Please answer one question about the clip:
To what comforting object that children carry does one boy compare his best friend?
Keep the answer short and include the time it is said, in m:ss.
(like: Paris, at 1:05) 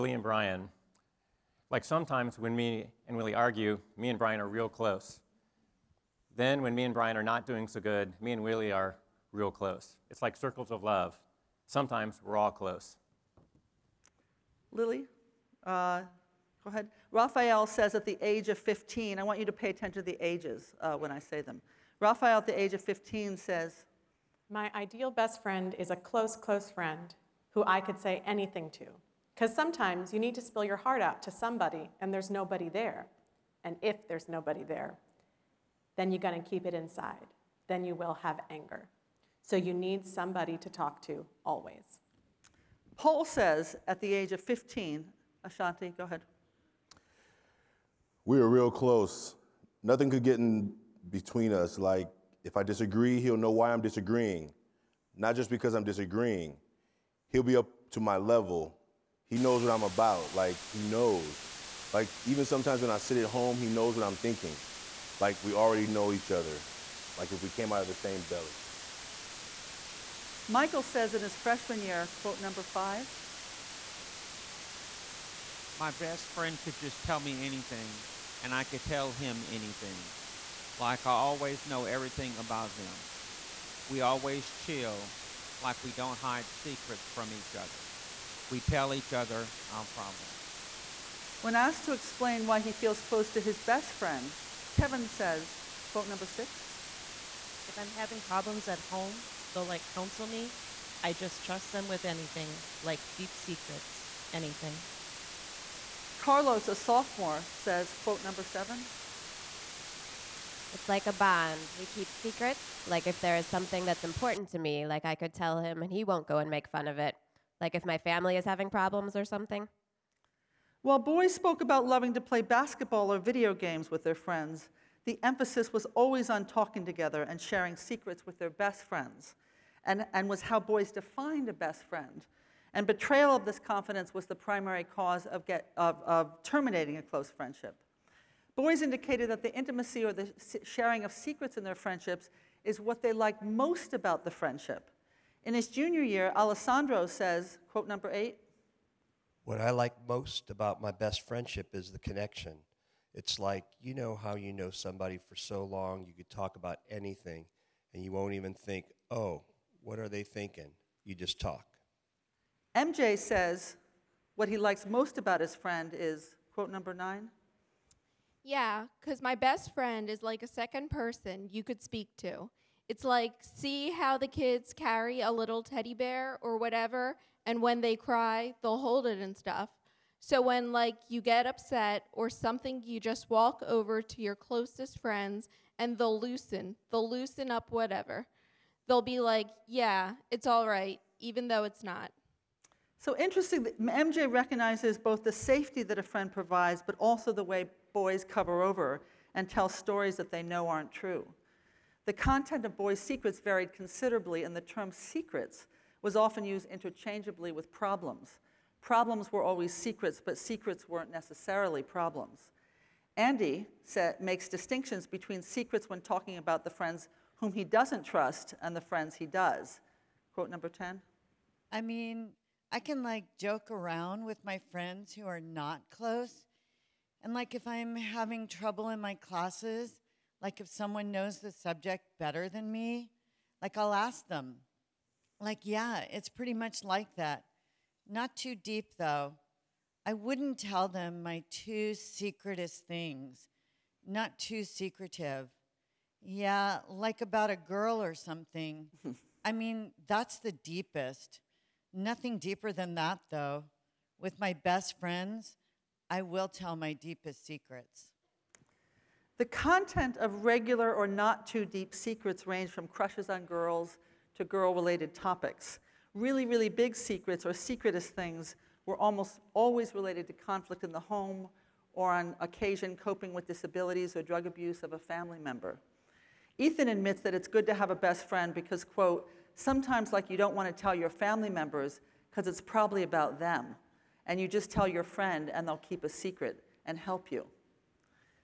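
teddy bear, at 2:55.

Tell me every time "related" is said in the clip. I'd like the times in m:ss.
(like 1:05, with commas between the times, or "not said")
4:24, 4:29.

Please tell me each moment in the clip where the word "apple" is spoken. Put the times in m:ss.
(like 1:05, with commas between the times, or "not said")
not said.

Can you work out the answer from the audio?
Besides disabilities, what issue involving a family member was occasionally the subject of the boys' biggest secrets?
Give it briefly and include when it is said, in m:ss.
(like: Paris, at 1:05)
drug abuse, at 4:34.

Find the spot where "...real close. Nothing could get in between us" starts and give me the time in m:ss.
0:48.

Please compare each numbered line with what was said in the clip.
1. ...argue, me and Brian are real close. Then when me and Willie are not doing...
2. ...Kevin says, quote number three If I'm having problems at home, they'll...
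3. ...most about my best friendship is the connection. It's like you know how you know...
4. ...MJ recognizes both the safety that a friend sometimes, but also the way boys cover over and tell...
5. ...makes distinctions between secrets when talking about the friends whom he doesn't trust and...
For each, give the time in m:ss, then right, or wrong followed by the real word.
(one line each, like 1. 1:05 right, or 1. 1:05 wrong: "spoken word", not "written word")
1. 0:03 wrong: "Brian", not "Willie"
2. 1:34 wrong: "six", not "three"
3. 2:30 right
4. 3:13 wrong: "provides", not "sometimes"
5. 3:34 right.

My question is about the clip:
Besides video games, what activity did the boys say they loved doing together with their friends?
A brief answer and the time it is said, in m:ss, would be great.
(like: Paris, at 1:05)
basketball, at 2:02.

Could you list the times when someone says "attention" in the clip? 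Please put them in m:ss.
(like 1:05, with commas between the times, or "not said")
0:19.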